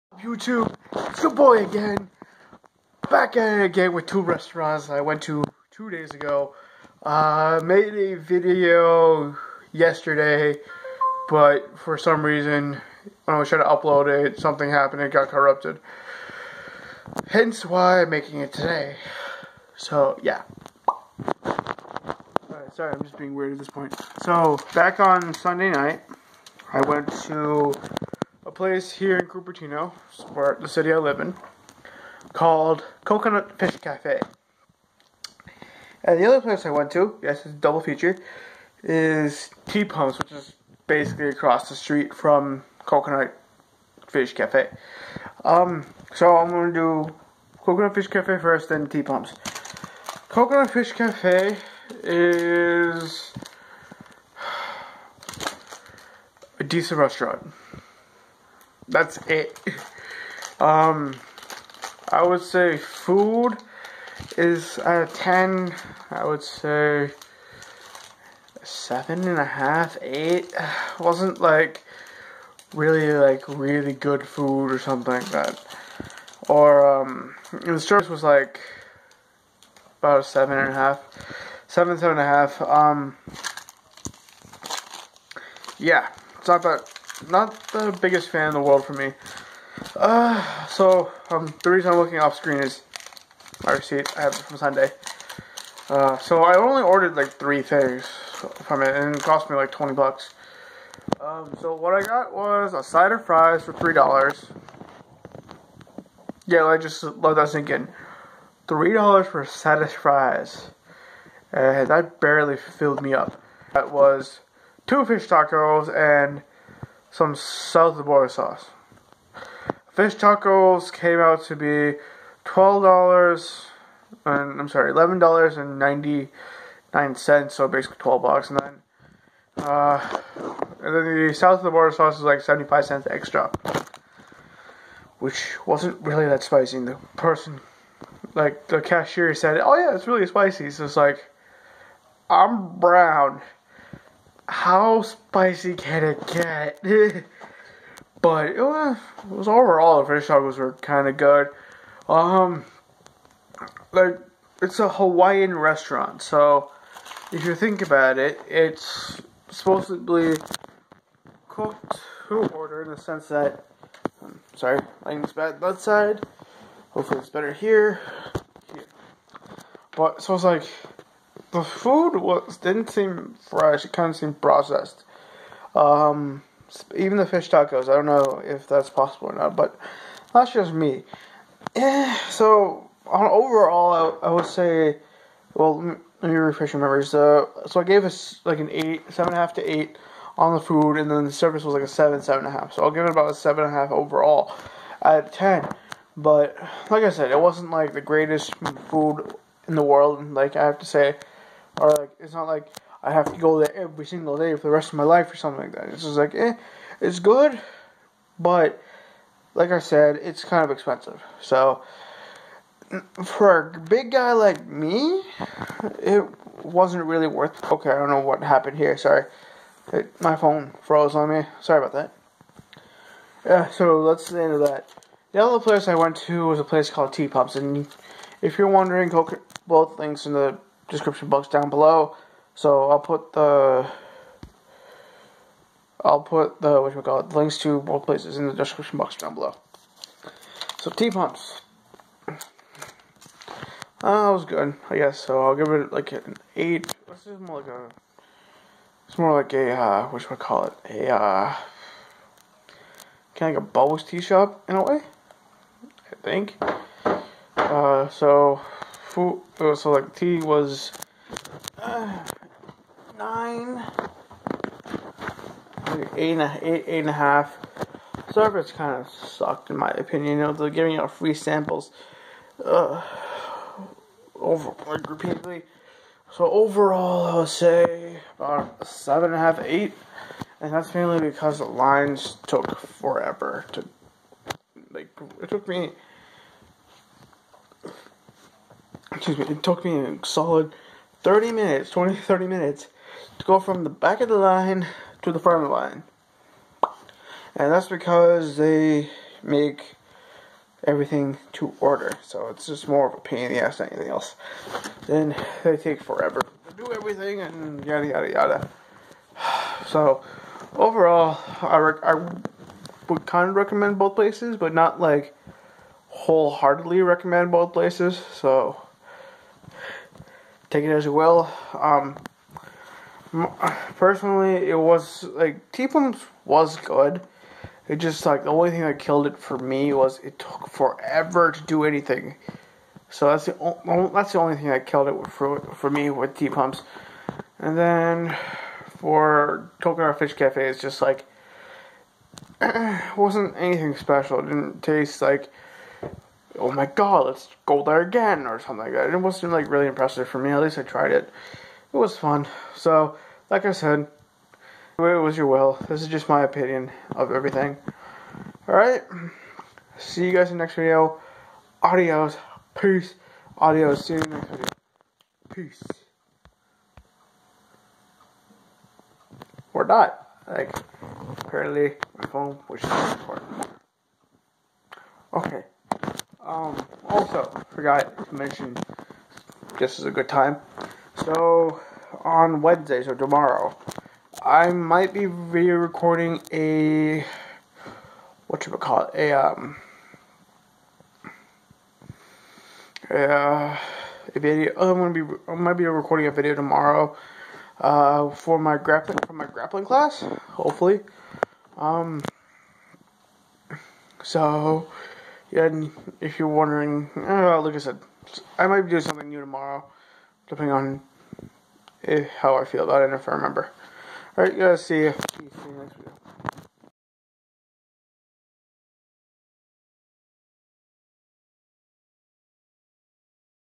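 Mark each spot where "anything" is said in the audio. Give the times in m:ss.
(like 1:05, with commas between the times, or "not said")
5:03, 5:31, 5:43.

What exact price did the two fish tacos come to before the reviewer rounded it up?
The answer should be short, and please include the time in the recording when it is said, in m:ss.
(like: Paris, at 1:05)
$11.99, at 2:04.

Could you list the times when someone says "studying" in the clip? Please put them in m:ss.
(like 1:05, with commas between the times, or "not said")
not said.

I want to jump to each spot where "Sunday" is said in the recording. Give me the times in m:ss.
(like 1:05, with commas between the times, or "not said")
0:25, 1:34.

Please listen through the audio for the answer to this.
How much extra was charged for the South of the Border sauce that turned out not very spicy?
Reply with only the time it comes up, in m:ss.
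2:12.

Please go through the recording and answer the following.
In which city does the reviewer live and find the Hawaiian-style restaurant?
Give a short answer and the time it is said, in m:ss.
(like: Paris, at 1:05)
Cupertino, at 0:29.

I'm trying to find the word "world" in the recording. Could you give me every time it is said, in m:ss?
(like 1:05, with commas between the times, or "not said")
1:28, 3:19.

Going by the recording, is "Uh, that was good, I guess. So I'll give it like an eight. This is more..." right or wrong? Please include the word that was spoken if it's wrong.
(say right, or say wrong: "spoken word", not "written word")
right.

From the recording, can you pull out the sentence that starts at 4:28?
Service kind of sucked in my opinion.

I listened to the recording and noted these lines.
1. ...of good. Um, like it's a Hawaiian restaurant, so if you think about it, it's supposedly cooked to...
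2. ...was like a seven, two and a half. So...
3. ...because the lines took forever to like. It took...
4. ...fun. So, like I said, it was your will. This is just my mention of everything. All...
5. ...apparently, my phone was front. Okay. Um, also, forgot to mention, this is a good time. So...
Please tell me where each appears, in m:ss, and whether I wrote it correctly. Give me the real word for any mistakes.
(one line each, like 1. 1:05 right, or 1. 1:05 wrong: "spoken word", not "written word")
1. 2:31 right
2. 3:11 wrong: "seven", not "two"
3. 4:41 right
4. 5:52 wrong: "opinion", not "mention"
5. 6:11 wrong: "important", not "front".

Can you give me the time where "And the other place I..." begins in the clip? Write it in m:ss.
0:36.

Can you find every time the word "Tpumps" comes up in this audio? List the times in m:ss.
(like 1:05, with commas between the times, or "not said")
0:39, 0:48, 3:47, 4:00.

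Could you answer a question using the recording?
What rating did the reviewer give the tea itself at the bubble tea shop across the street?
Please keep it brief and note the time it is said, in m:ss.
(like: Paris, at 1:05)
9.5, at 4:23.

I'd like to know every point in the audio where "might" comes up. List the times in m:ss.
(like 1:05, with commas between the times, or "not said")
6:24, 6:35, 6:48.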